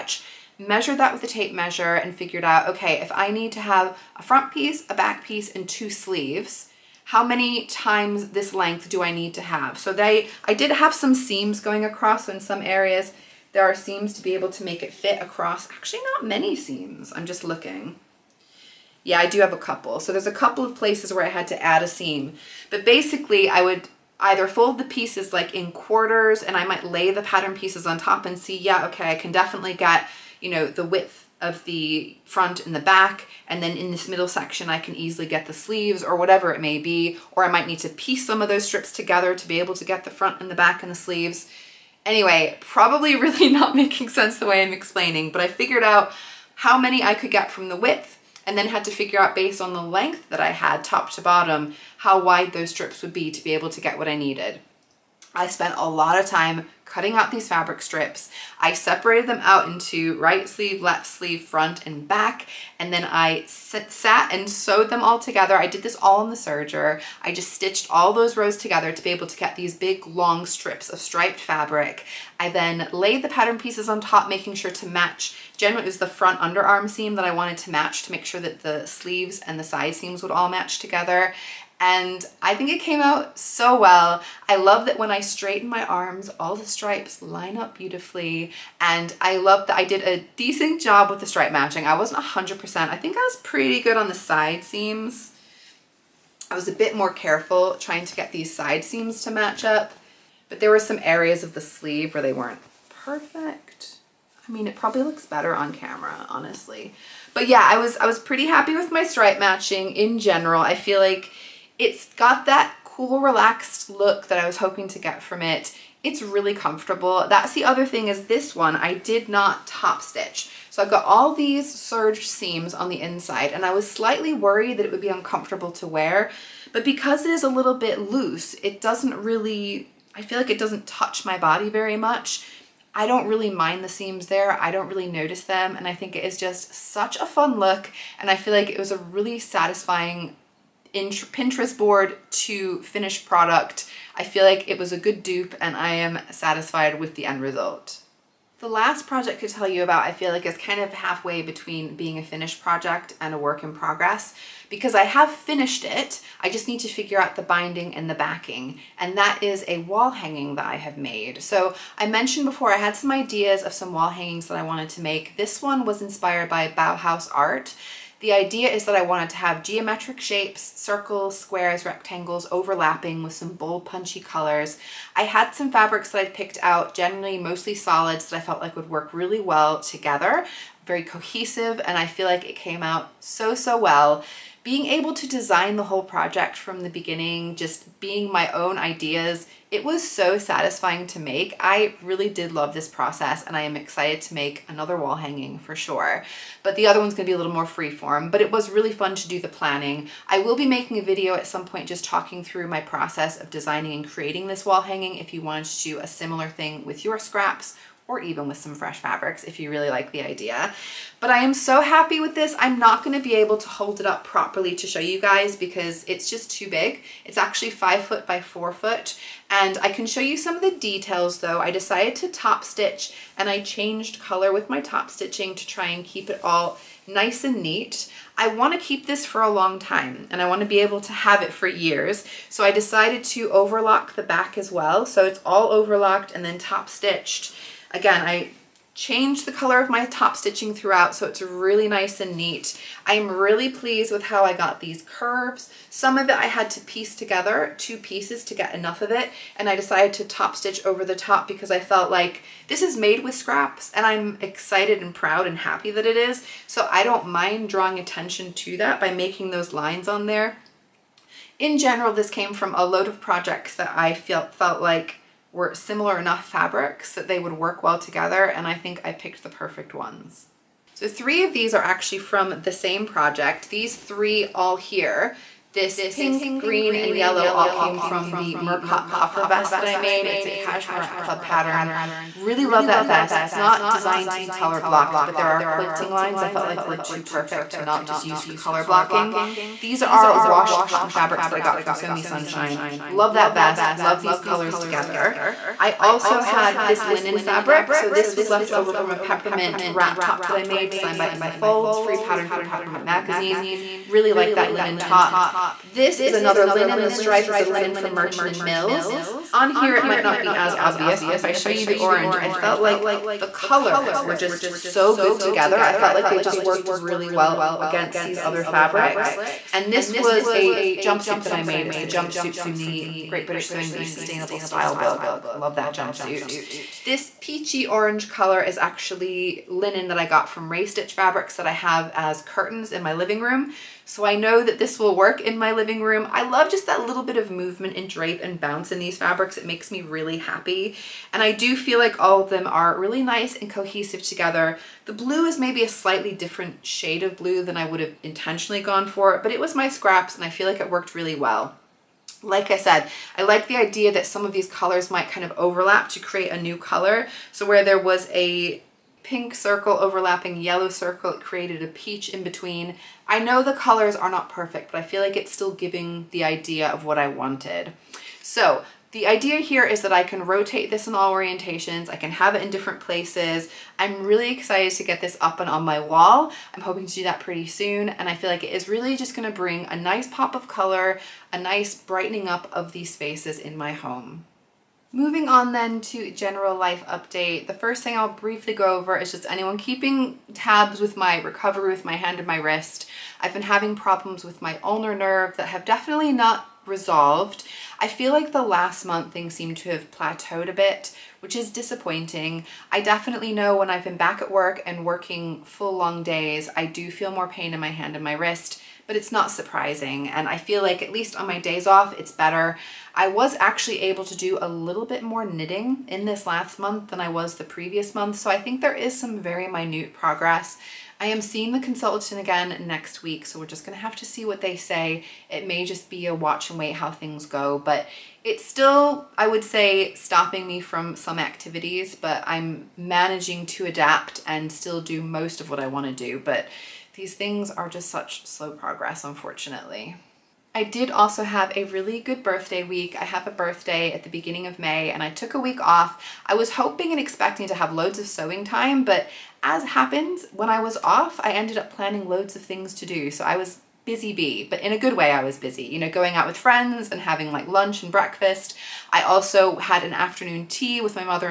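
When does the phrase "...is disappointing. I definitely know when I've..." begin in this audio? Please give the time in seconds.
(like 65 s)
401 s.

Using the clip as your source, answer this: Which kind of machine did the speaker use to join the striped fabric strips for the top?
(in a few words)
serger.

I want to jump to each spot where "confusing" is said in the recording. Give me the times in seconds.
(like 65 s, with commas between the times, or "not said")
not said.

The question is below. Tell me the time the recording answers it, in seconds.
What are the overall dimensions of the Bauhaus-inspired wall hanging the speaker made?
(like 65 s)
217 s.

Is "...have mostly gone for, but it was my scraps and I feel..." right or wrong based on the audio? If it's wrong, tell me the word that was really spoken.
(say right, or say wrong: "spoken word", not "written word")
wrong: "intentionally", not "mostly".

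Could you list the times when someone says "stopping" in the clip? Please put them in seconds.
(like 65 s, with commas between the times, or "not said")
430 s.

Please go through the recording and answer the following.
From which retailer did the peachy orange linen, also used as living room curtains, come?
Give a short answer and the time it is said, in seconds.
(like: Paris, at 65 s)
Raystitch Fabrics, at 330 s.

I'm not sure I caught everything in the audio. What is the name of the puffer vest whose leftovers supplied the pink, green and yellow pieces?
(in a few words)
Murcott.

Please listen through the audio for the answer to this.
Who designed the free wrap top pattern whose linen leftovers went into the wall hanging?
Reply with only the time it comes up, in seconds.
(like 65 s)
301 s.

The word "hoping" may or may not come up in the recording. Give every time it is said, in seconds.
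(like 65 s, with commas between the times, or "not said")
114 s, 376 s, 446 s.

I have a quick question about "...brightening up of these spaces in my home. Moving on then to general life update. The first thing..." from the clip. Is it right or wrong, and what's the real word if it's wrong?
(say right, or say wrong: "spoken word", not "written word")
right.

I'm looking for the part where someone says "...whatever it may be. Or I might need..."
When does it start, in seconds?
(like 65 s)
36 s.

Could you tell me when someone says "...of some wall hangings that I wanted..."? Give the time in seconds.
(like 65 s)
163 s.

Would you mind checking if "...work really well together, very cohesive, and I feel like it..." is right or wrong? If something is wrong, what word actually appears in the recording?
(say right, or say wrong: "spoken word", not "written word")
right.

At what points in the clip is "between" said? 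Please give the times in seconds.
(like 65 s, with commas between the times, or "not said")
151 s, 362 s.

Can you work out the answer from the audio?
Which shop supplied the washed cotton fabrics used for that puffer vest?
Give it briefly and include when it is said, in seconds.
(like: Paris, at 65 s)
Sew Me Sunshine, at 291 s.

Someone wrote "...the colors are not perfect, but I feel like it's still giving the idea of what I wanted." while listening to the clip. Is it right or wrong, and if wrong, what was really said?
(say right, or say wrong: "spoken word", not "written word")
right.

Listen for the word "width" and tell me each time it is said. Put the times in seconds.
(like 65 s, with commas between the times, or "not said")
30 s, 47 s.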